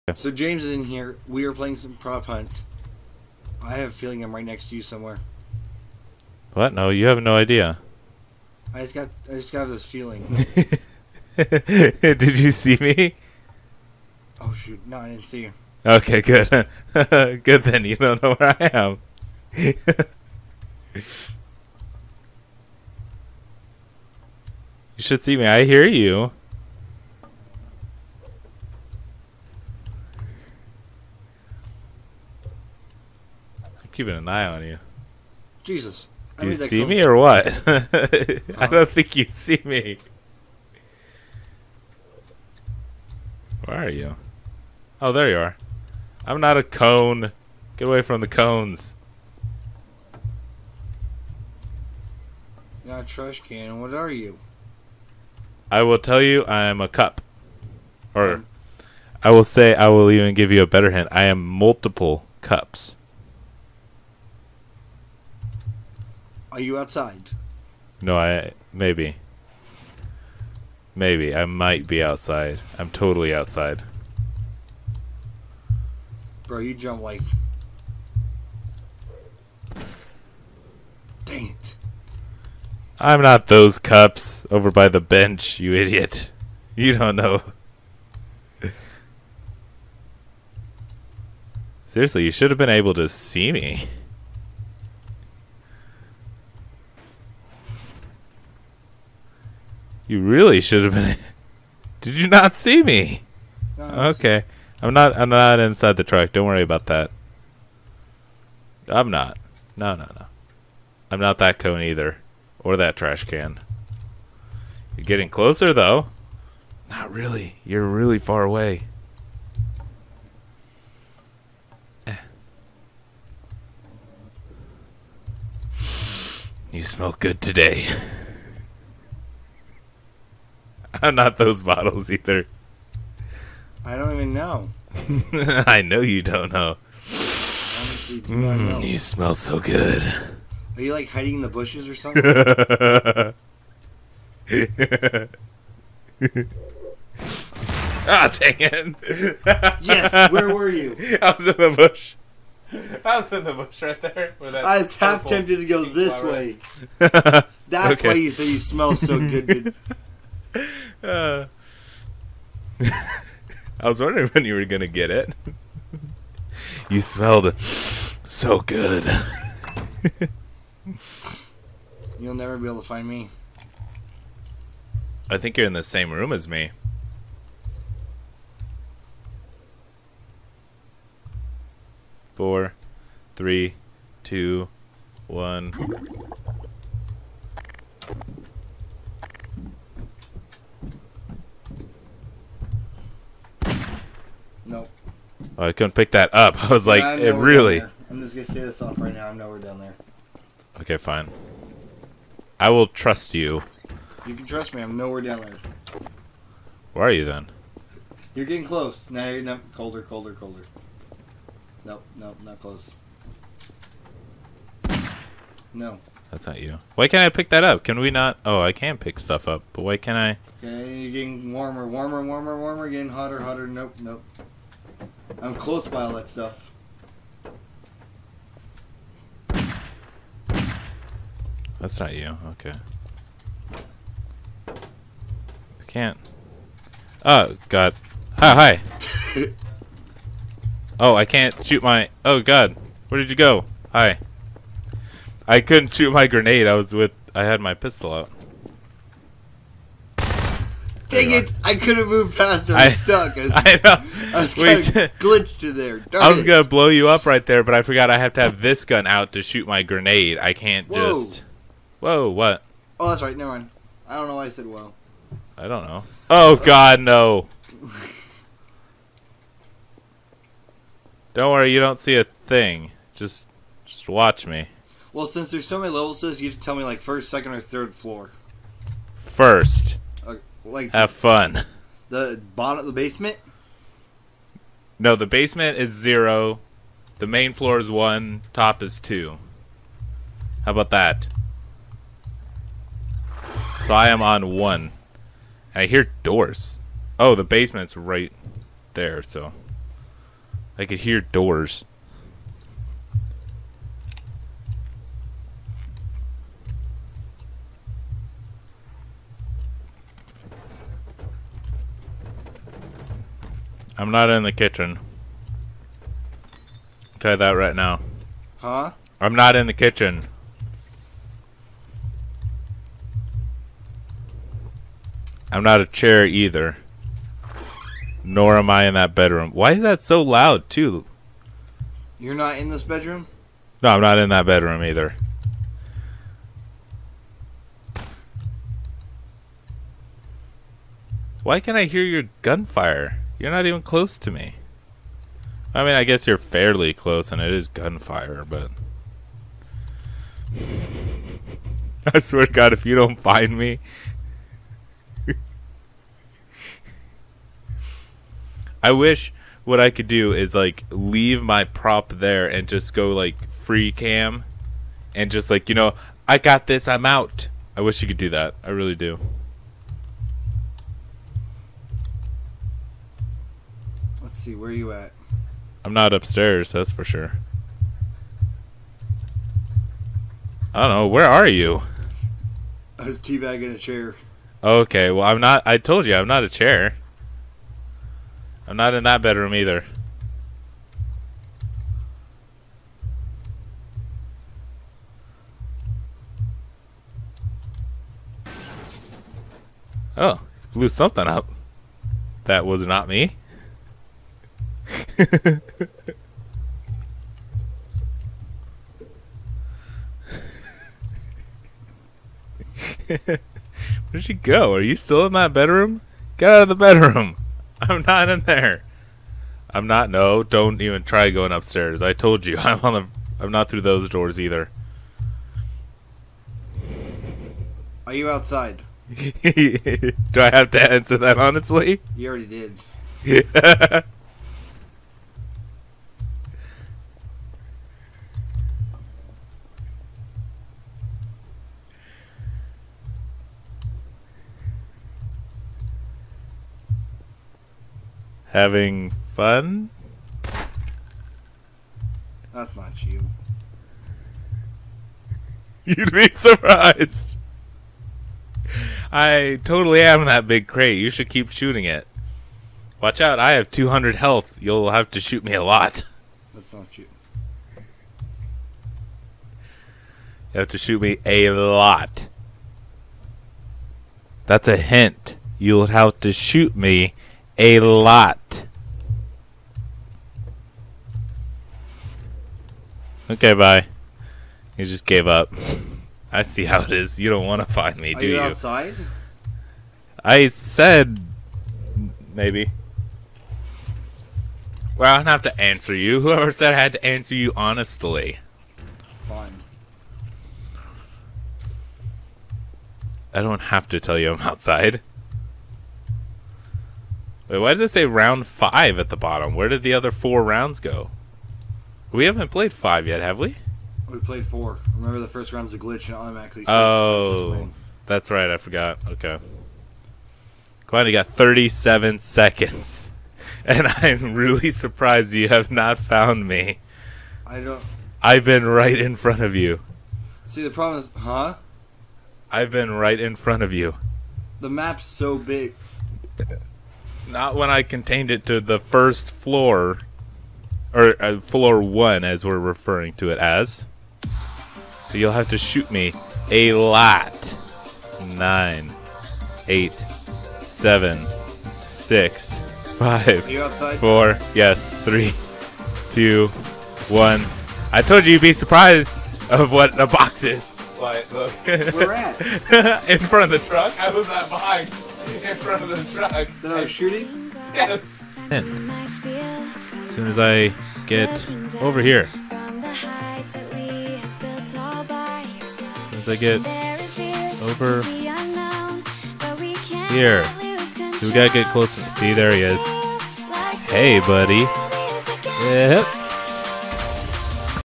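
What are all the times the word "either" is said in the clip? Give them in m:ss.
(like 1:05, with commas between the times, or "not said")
1:51, 2:12, 5:26, 5:34, 6:29, 7:04.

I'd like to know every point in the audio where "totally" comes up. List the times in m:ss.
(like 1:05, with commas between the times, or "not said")
1:12, 7:39.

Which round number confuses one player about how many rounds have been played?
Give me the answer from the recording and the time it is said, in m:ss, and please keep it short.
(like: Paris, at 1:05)
5, at 8:28.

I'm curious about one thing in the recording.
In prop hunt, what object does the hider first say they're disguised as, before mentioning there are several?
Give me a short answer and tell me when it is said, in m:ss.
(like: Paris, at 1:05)
A cup, at 0:56.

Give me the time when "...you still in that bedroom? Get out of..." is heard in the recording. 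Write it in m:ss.
6:54.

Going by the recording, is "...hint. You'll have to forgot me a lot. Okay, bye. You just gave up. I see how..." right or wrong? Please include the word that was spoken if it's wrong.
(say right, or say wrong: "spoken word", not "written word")
wrong: "shoot", not "forgot".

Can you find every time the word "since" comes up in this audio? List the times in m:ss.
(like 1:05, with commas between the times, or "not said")
4:35.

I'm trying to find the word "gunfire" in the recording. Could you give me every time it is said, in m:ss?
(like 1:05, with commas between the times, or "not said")
5:42, 5:47.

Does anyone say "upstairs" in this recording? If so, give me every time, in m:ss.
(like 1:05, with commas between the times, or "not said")
6:16, 7:01.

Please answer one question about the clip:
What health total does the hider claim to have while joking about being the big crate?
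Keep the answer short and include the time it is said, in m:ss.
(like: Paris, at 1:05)
200, at 7:43.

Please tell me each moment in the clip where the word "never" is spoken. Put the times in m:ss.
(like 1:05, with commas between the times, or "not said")
2:52, 4:23.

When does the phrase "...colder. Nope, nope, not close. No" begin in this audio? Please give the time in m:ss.
3:30.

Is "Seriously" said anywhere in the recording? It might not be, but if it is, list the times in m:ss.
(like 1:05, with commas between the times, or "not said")
1:31.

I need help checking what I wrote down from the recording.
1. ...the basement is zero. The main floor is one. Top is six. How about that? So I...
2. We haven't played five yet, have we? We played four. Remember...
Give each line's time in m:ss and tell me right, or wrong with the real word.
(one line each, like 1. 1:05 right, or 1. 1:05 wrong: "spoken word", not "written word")
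1. 4:45 wrong: "two", not "six"
2. 8:32 right.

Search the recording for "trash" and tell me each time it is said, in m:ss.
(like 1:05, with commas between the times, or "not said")
0:53, 1:52.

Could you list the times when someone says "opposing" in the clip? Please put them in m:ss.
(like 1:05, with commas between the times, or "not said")
not said.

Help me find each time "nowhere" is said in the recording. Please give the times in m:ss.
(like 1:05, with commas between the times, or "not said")
3:19, 3:24.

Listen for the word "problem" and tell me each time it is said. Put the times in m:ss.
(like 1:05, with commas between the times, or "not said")
8:50.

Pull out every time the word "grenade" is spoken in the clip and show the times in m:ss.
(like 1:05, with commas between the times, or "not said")
4:06, 4:19.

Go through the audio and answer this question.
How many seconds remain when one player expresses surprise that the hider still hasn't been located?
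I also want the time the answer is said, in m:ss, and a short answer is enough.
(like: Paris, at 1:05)
37, at 8:41.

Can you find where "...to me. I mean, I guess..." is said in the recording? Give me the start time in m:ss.
5:44.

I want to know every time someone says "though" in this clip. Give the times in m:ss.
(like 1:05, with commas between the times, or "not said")
1:55.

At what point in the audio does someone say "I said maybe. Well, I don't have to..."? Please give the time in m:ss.
8:10.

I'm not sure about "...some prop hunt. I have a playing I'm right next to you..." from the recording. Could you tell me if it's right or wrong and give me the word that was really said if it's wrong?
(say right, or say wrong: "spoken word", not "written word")
wrong: "feeling", not "playing".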